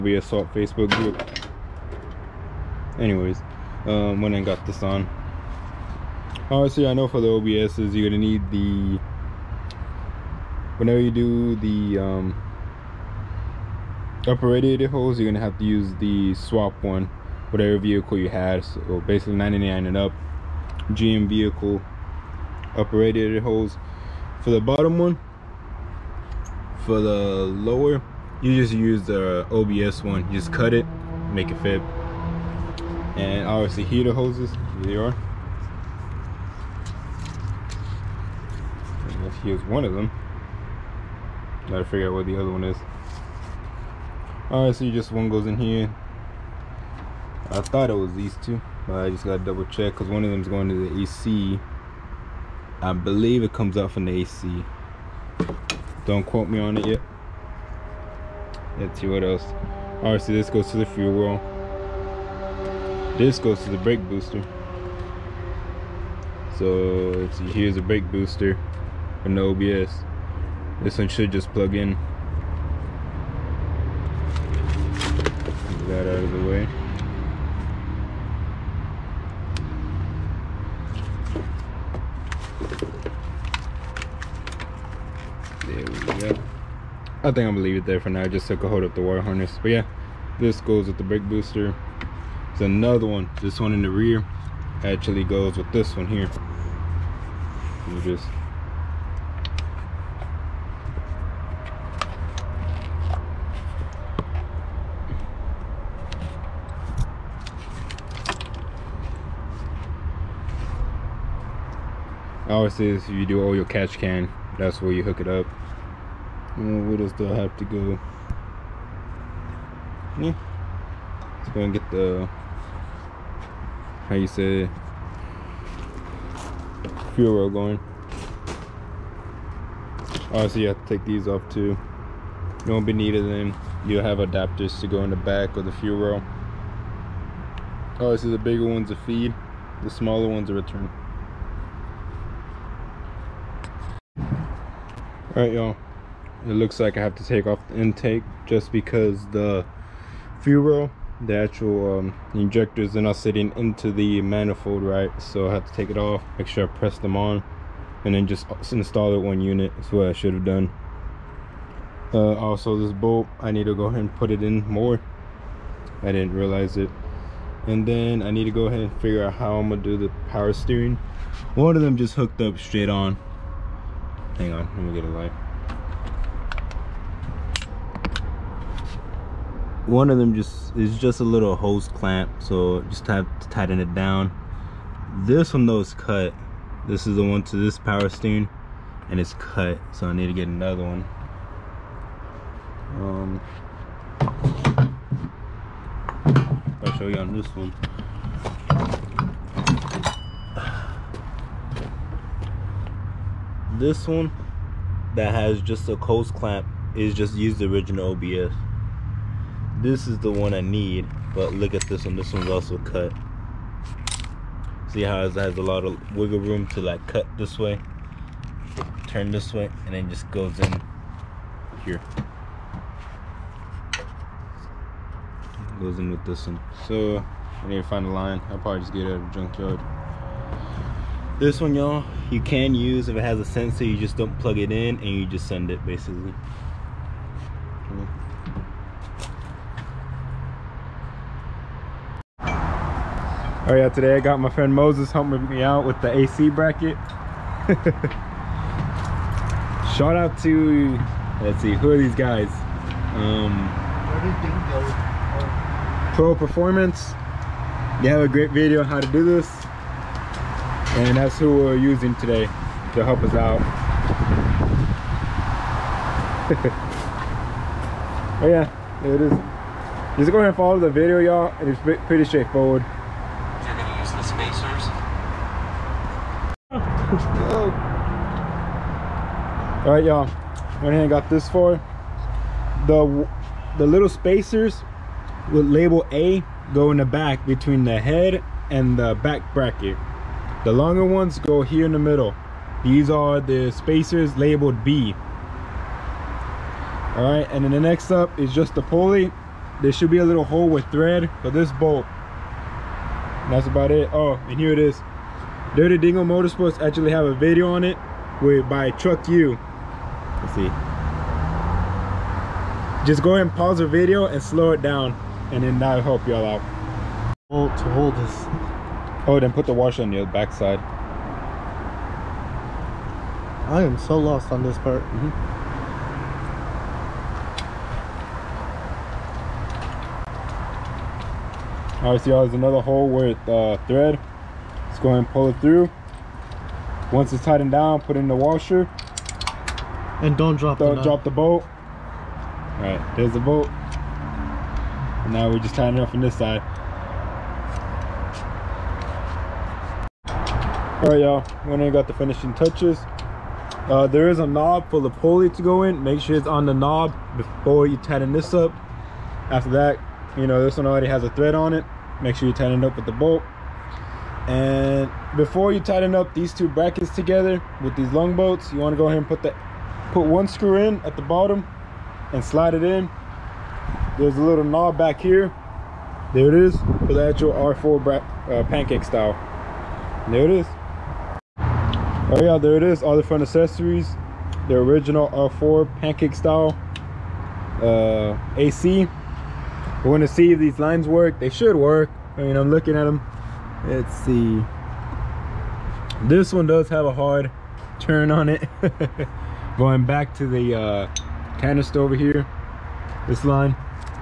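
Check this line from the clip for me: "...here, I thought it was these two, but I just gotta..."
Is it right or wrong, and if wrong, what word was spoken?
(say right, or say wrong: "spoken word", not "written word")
right.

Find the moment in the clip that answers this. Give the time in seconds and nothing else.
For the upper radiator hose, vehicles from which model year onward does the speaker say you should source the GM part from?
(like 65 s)
19 s.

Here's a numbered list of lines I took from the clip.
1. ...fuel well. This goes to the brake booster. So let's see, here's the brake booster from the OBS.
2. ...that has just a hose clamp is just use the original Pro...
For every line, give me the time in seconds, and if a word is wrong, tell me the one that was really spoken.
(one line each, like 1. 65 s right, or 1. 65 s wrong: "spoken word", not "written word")
1. 60 s right
2. 205 s wrong: "OBS", not "Pro".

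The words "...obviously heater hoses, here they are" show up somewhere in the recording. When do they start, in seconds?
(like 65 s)
33 s.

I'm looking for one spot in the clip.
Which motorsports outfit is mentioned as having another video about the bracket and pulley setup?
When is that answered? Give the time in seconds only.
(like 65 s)
305 s.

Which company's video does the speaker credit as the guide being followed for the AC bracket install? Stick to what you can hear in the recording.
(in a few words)
Pro Performance.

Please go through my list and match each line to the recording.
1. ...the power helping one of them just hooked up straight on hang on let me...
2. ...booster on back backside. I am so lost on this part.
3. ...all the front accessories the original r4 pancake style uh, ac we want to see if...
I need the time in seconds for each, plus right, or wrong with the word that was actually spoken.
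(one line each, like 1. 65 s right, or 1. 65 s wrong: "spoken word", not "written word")
1. 169 s wrong: "steering", not "helping"
2. 319 s wrong: "washer", not "booster"
3. 383 s right.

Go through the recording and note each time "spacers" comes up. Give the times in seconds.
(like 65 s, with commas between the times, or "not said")
284 s, 293 s.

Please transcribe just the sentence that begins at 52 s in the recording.
I believe it comes out from the AC.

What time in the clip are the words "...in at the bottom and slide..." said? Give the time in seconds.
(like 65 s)
370 s.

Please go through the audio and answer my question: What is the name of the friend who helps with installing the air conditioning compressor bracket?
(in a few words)
Moses.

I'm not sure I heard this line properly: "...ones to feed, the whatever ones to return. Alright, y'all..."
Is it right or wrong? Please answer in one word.
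wrong.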